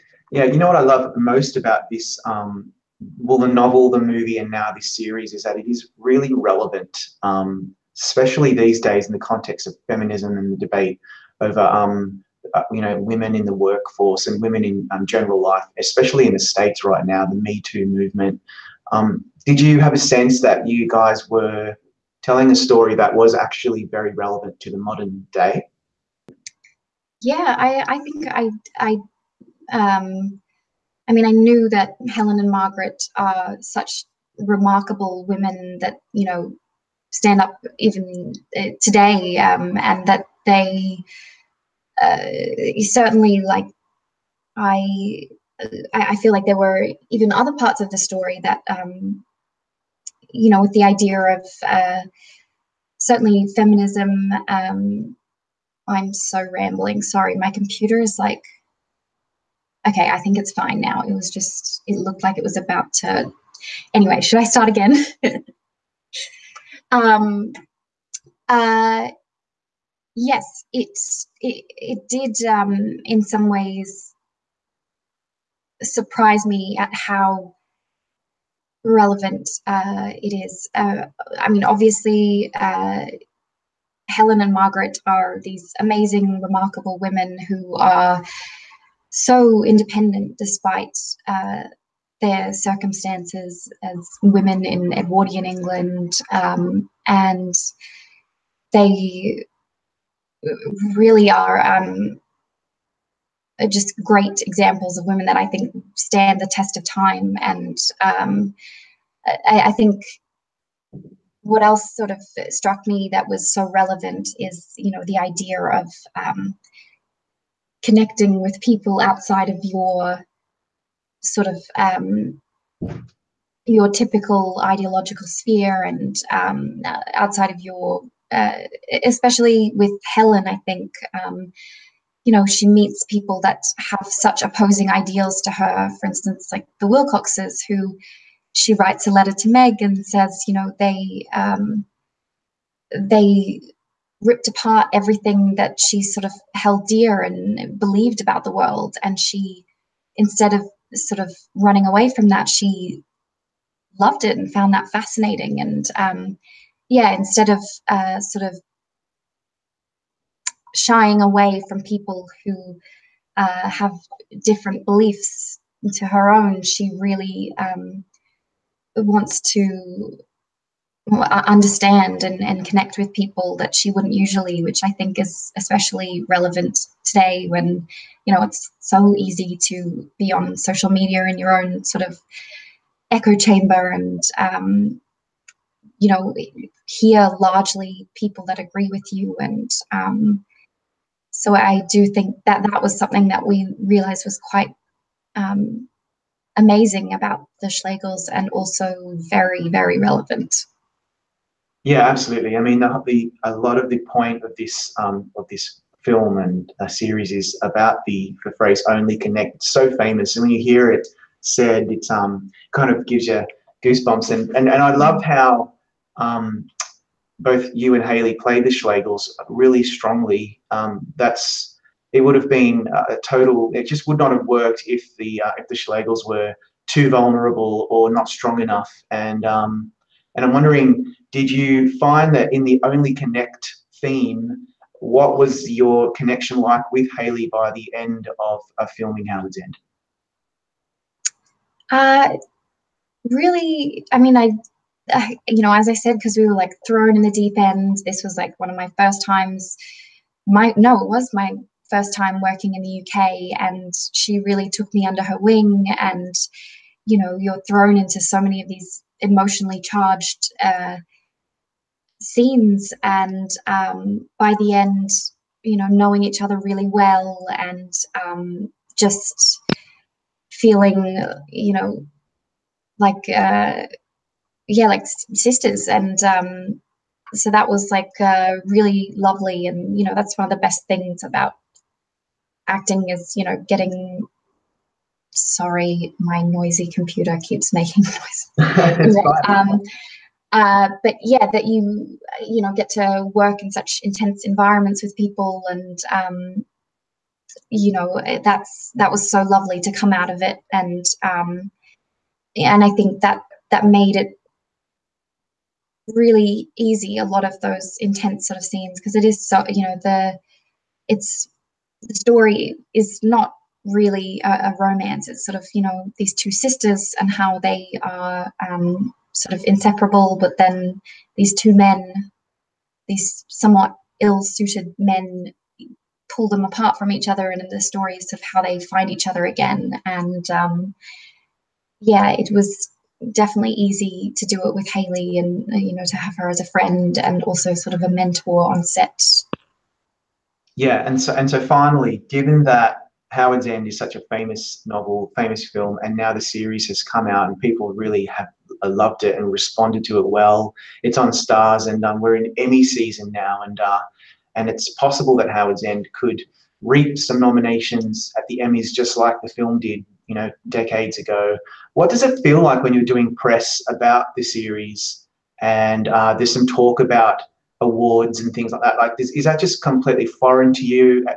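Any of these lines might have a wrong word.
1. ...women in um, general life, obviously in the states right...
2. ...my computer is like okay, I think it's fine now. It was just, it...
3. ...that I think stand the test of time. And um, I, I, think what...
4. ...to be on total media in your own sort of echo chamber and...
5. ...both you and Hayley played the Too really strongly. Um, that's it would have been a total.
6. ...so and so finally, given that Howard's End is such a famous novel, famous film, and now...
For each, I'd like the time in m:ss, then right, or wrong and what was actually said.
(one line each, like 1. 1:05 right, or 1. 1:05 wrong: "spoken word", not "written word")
1. 0:14 wrong: "especially", not "obviously"
2. 0:57 right
3. 1:45 right
4. 2:59 wrong: "social", not "total"
5. 3:37 wrong: "Schlegels", not "Too"
6. 5:41 right.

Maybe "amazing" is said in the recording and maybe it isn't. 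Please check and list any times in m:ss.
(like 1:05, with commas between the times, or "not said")
1:25, 3:16.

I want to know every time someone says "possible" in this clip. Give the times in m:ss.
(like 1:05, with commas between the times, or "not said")
5:54.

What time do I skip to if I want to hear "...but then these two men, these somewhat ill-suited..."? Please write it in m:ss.
5:20.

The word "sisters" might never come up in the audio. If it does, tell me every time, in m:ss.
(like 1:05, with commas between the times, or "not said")
4:35, 5:16.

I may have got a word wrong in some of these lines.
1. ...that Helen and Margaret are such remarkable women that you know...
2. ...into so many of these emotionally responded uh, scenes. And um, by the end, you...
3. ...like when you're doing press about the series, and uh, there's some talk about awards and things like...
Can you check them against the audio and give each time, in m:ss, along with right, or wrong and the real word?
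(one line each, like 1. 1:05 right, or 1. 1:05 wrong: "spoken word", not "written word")
1. 0:31 right
2. 4:17 wrong: "charged", not "responded"
3. 6:02 right.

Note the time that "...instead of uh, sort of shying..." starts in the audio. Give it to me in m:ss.
2:37.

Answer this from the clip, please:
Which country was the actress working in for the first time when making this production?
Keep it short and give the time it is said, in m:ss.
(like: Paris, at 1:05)
the UK, at 4:12.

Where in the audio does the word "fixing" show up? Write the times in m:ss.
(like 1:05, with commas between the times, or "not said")
not said.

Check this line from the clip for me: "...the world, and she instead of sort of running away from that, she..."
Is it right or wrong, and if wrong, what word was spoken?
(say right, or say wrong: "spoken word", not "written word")
right.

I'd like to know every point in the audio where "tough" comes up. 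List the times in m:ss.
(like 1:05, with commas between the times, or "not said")
not said.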